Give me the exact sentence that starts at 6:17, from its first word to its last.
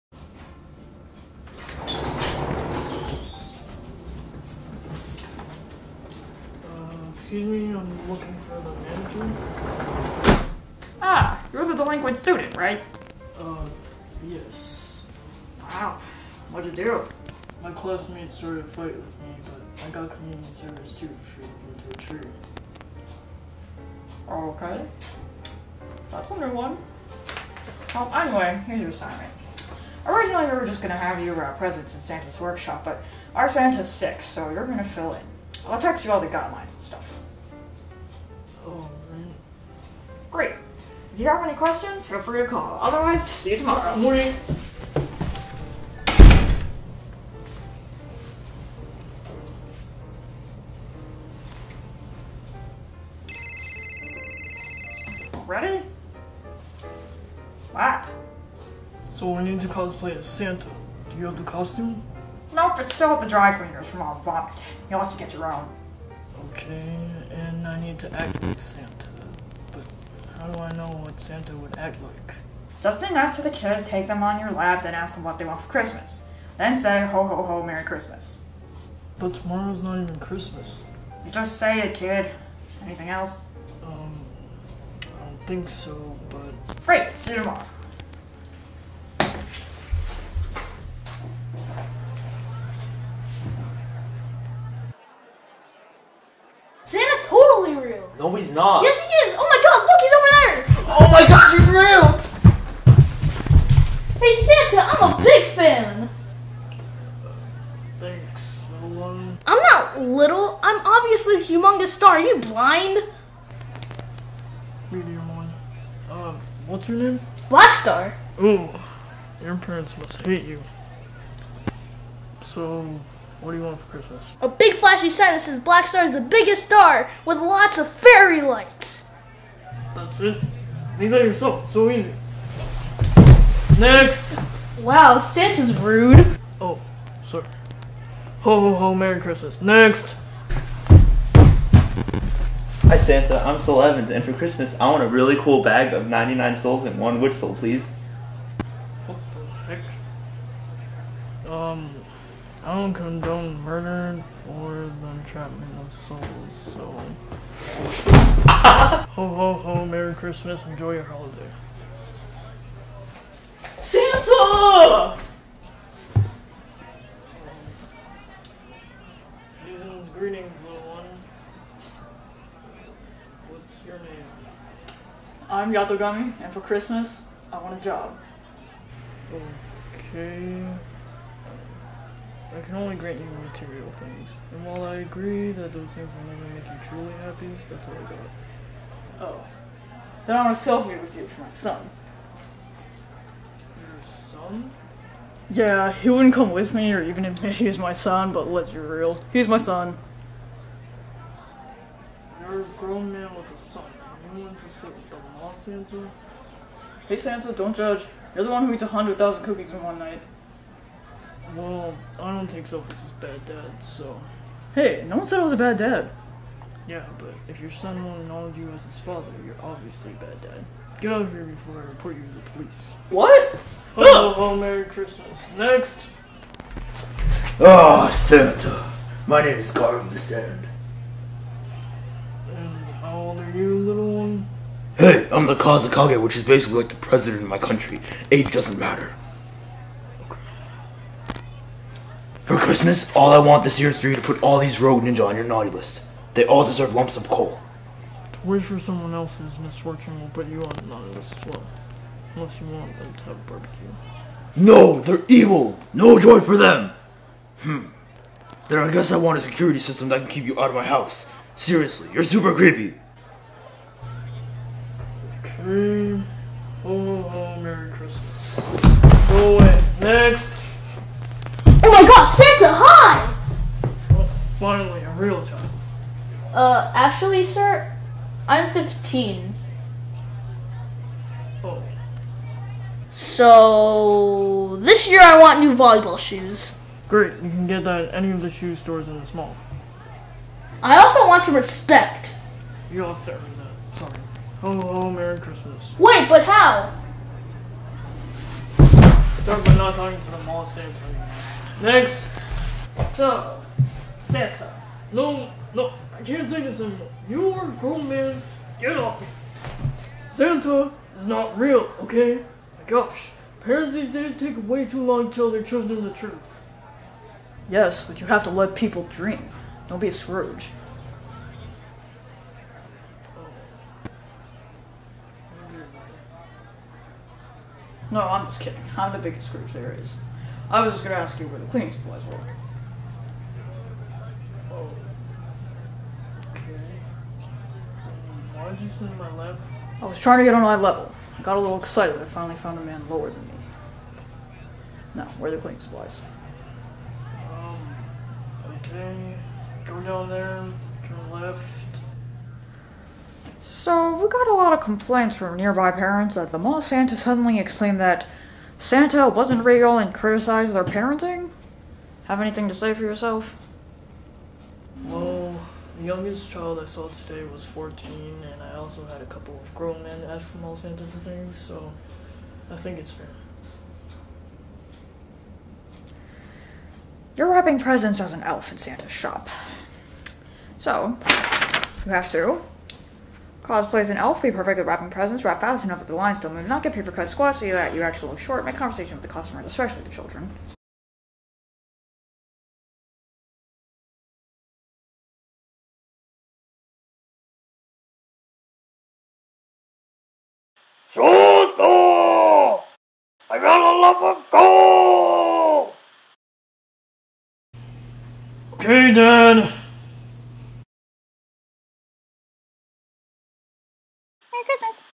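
You're wrapping presents as an elf in Santa's shop.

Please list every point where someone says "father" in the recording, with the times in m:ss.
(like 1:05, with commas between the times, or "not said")
3:39.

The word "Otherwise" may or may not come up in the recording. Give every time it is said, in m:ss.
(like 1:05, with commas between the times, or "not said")
0:42.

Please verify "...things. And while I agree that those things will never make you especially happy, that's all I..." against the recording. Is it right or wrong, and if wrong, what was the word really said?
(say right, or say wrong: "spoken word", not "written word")
wrong: "truly", not "especially".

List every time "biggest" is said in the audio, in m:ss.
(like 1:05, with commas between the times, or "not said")
2:06, 5:29.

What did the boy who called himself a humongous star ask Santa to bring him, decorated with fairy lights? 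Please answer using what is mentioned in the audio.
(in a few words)
A big flashy sign.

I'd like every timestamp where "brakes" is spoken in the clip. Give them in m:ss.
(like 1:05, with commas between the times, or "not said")
not said.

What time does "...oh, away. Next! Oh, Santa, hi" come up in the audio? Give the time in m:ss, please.
4:29.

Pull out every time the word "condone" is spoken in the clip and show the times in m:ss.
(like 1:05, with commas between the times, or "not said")
2:32.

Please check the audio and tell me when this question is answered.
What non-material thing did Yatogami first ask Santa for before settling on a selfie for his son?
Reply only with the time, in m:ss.
2:57.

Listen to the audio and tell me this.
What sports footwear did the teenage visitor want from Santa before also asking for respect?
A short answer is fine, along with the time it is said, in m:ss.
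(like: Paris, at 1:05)
Volleyball shoes, at 4:45.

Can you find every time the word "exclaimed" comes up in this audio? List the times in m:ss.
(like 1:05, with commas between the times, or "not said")
5:57.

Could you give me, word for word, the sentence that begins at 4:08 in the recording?
To wish for someone else's misfortune will put you on the naughty list as well.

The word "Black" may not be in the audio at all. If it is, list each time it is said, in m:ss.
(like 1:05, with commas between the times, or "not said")
1:57, 2:05.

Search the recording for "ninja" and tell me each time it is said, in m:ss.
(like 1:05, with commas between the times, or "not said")
4:05.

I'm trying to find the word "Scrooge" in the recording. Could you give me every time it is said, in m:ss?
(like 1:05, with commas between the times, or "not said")
5:20, 5:29.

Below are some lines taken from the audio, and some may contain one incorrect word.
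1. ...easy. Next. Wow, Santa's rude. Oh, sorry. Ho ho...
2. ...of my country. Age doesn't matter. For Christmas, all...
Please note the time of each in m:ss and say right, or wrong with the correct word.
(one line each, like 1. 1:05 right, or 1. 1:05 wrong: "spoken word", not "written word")
1. 2:11 right
2. 3:57 right.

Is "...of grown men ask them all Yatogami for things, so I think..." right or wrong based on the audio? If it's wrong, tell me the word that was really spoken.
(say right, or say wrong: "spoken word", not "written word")
wrong: "Santa", not "Yatogami".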